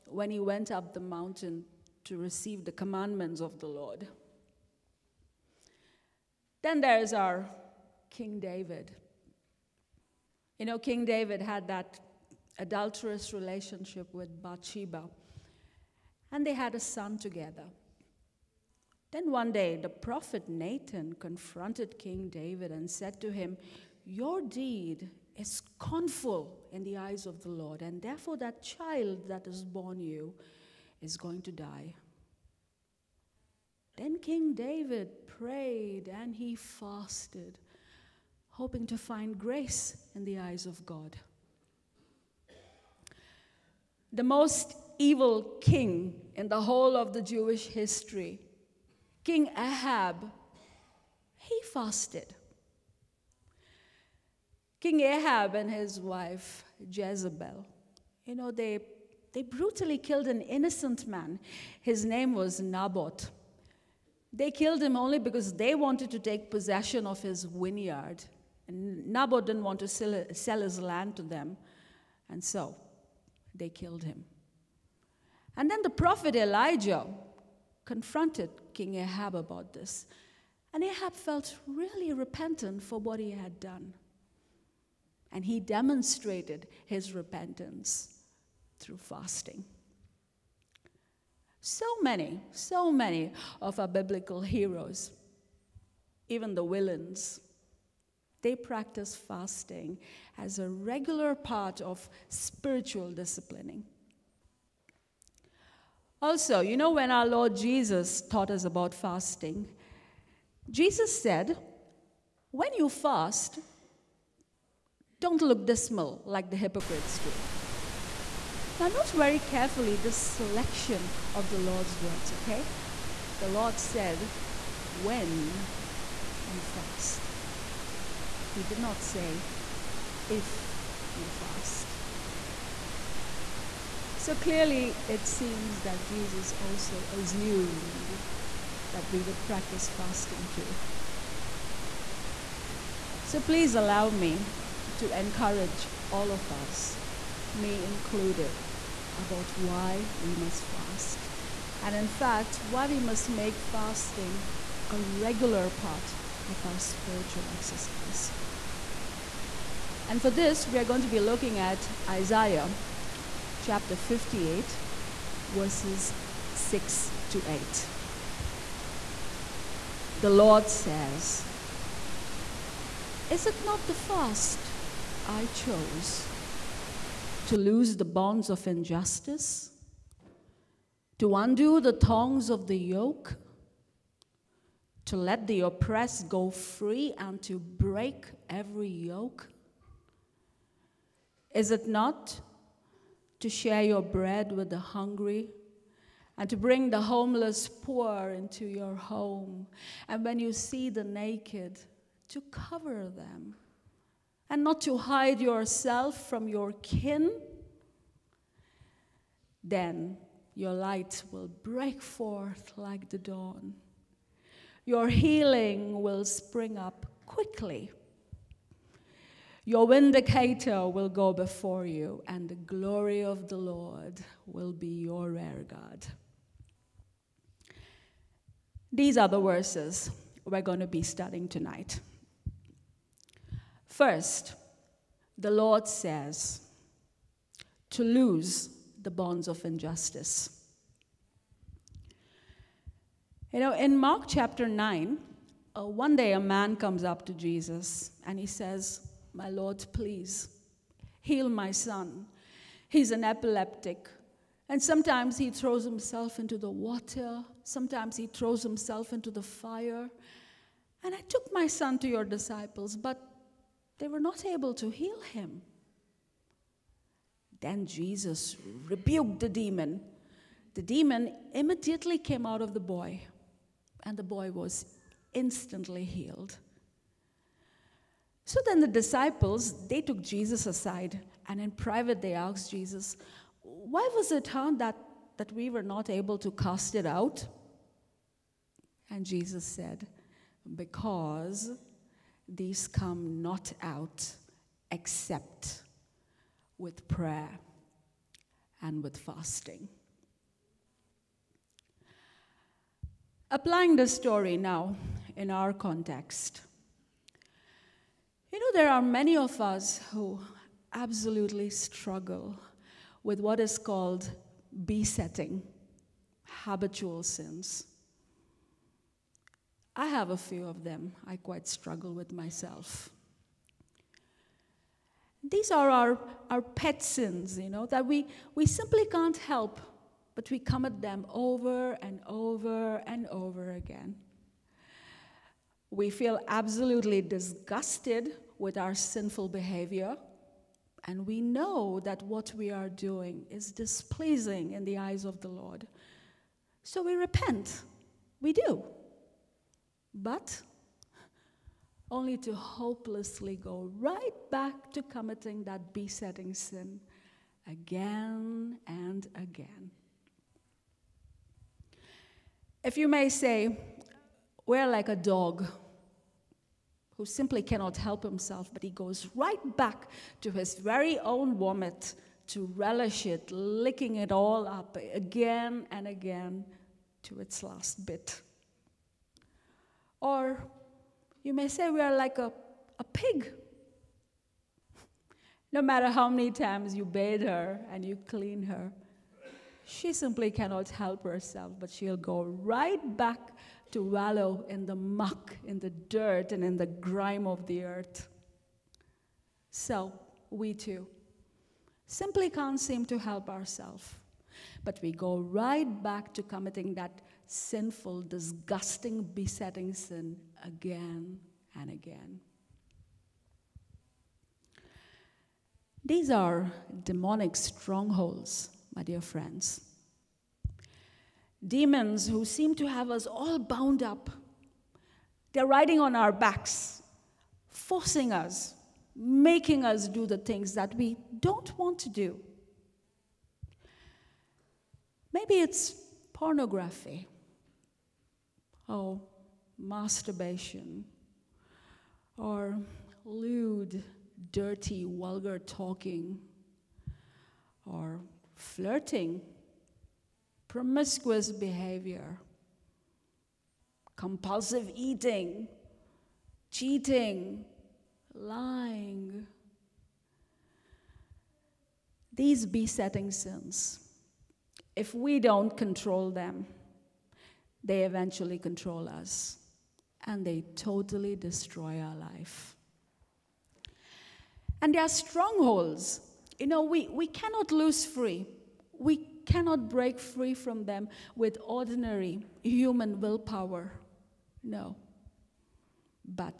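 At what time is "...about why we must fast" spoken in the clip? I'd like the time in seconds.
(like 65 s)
149 s.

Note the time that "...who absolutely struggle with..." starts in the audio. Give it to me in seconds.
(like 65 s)
310 s.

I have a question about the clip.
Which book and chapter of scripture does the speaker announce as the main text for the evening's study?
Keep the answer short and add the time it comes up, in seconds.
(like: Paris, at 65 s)
Isaiah 58, at 162 s.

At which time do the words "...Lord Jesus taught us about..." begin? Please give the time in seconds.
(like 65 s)
107 s.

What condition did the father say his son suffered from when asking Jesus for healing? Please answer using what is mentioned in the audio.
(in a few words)
Epileptic.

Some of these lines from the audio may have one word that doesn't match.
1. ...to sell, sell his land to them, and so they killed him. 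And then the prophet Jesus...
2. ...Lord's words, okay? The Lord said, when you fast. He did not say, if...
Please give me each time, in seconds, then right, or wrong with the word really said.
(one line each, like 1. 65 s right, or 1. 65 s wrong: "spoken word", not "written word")
1. 69 s wrong: "Elijah", not "Jesus"
2. 121 s right.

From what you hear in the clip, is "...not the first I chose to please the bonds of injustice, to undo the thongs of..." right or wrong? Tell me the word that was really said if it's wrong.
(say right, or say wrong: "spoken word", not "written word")
wrong: "loose", not "please".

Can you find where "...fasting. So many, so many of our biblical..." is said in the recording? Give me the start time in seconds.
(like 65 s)
88 s.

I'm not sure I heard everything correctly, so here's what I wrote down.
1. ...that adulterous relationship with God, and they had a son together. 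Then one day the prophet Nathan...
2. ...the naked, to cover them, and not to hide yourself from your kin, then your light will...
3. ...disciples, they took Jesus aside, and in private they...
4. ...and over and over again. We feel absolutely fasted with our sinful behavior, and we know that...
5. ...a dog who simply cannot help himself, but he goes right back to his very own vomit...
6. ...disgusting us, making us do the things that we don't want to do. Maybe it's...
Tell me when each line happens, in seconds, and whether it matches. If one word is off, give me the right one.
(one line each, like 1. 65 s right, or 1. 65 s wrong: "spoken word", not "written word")
1. 11 s wrong: "Bathsheba", not "God"
2. 200 s right
3. 278 s right
4. 332 s wrong: "disgusted", not "fasted"
5. 365 s right
6. 427 s wrong: "forcing", not "disgusting".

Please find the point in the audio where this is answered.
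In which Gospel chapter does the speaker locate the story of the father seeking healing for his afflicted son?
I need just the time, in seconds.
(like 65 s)
243 s.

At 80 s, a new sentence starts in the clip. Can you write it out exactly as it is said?
And Ahab felt really repentant for what he had done.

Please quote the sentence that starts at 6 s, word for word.
Then there is our King David.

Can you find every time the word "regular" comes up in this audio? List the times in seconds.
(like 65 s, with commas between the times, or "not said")
100 s, 154 s.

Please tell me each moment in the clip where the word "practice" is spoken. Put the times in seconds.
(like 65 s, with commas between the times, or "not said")
98 s, 139 s.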